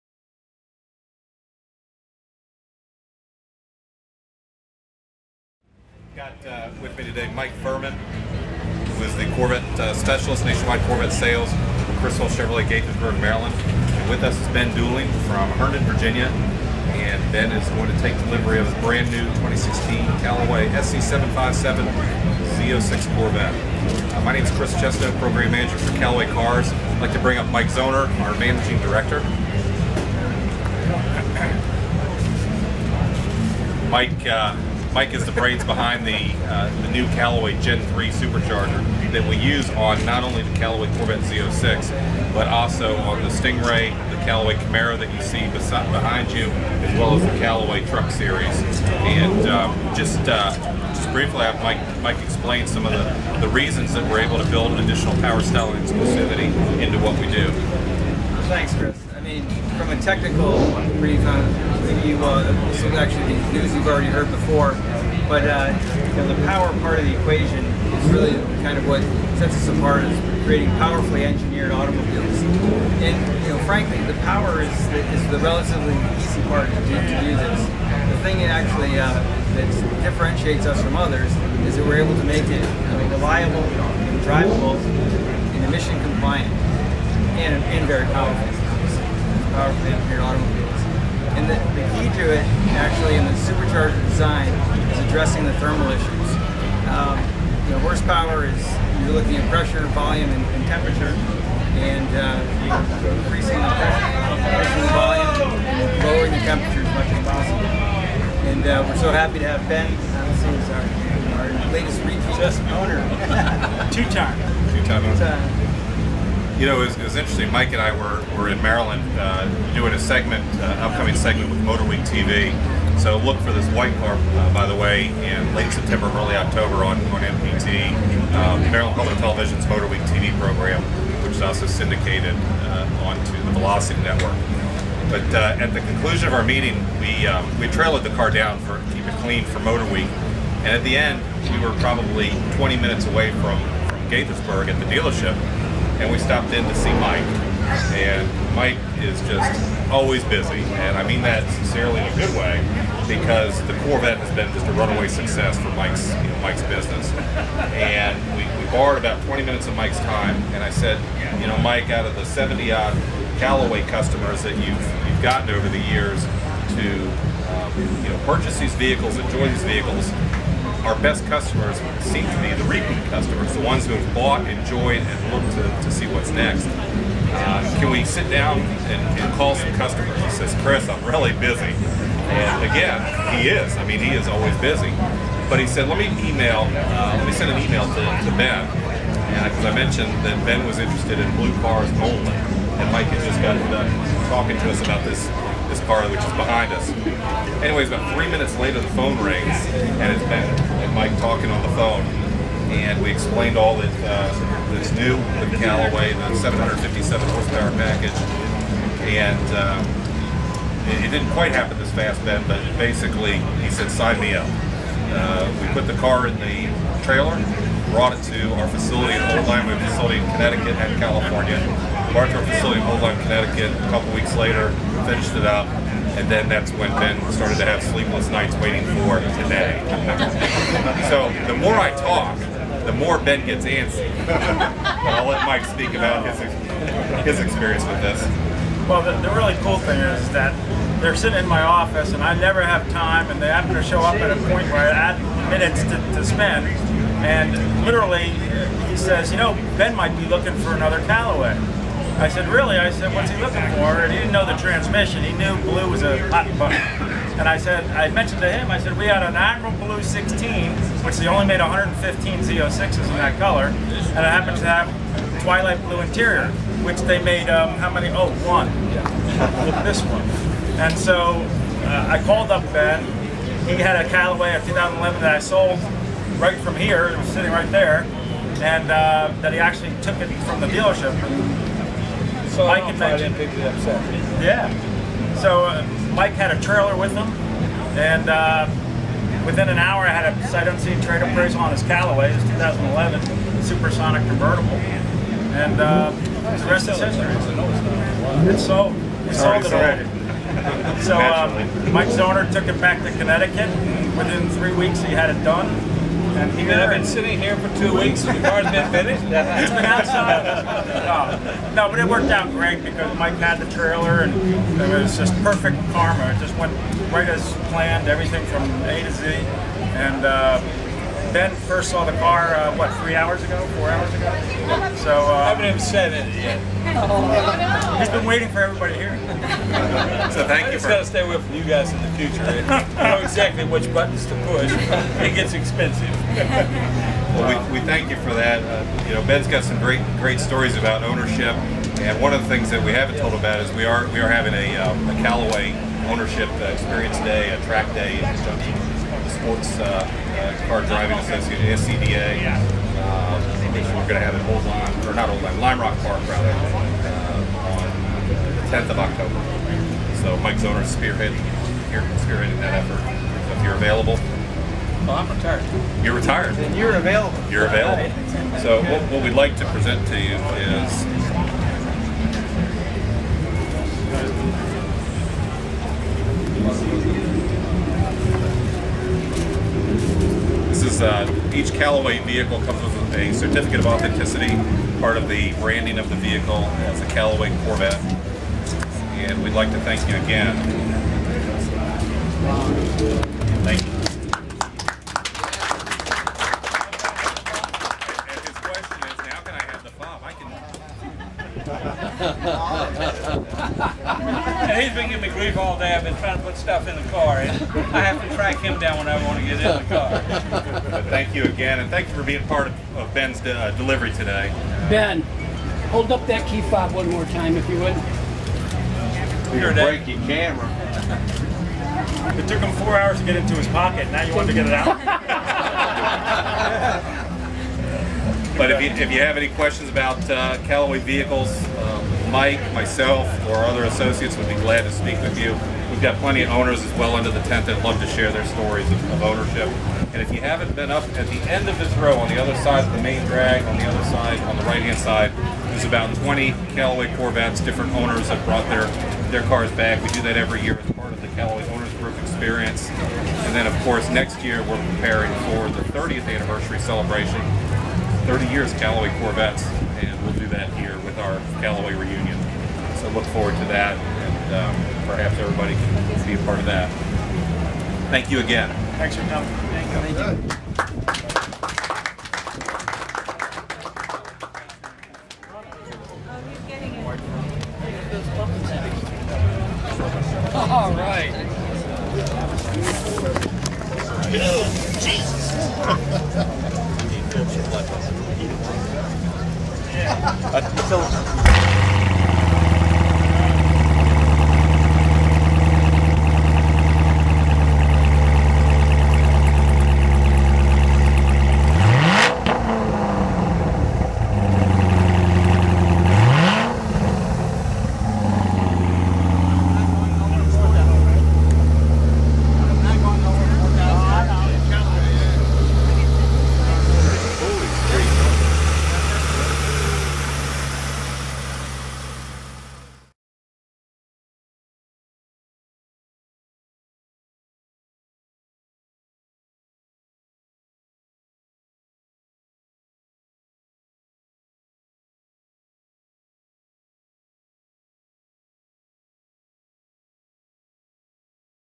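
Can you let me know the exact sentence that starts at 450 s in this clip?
We do that every year as part of the Callaway Owners Group experience.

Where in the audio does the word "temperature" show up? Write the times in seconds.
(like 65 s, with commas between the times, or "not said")
100 s, 106 s.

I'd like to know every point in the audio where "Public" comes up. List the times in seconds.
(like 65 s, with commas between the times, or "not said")
128 s.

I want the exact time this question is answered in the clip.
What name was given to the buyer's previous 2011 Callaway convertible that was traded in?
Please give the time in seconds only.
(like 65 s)
293 s.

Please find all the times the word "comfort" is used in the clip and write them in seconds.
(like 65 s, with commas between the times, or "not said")
not said.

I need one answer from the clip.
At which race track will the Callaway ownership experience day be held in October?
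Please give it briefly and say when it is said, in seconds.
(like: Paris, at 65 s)
Lime Rock Park, at 355 s.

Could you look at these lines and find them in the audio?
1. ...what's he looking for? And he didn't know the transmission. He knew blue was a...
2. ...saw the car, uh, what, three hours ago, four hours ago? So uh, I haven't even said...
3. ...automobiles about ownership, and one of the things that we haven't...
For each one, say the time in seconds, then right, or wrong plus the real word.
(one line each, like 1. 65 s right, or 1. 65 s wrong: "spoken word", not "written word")
1. 253 s right
2. 321 s right
3. 340 s wrong: "stories", not "automobiles".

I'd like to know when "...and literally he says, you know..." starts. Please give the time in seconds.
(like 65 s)
247 s.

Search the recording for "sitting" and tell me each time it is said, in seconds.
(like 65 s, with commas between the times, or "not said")
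241 s, 277 s, 307 s.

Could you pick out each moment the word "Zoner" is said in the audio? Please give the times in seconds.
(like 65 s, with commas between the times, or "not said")
27 s, 302 s, 360 s.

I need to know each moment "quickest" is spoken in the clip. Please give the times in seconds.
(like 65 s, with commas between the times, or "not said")
not said.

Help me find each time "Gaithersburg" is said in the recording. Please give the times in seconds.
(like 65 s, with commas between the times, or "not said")
12 s, 144 s.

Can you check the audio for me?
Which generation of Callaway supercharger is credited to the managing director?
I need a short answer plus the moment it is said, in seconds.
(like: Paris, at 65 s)
Gen 3, at 37 s.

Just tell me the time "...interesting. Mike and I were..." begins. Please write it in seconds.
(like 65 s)
117 s.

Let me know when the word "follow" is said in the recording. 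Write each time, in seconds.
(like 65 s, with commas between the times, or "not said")
not said.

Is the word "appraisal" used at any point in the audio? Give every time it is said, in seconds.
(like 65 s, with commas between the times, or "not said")
291 s.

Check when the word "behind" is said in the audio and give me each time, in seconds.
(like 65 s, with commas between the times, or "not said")
35 s, 45 s, 196 s.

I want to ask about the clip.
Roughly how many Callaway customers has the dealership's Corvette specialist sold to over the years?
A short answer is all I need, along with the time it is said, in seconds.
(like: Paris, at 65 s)
70, at 162 s.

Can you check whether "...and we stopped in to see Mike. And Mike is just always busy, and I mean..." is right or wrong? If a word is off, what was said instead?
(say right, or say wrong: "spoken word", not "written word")
right.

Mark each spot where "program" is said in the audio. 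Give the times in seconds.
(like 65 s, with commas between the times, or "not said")
25 s, 130 s.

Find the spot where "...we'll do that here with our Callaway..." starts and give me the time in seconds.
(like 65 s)
460 s.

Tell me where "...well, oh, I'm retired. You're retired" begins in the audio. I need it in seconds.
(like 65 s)
364 s.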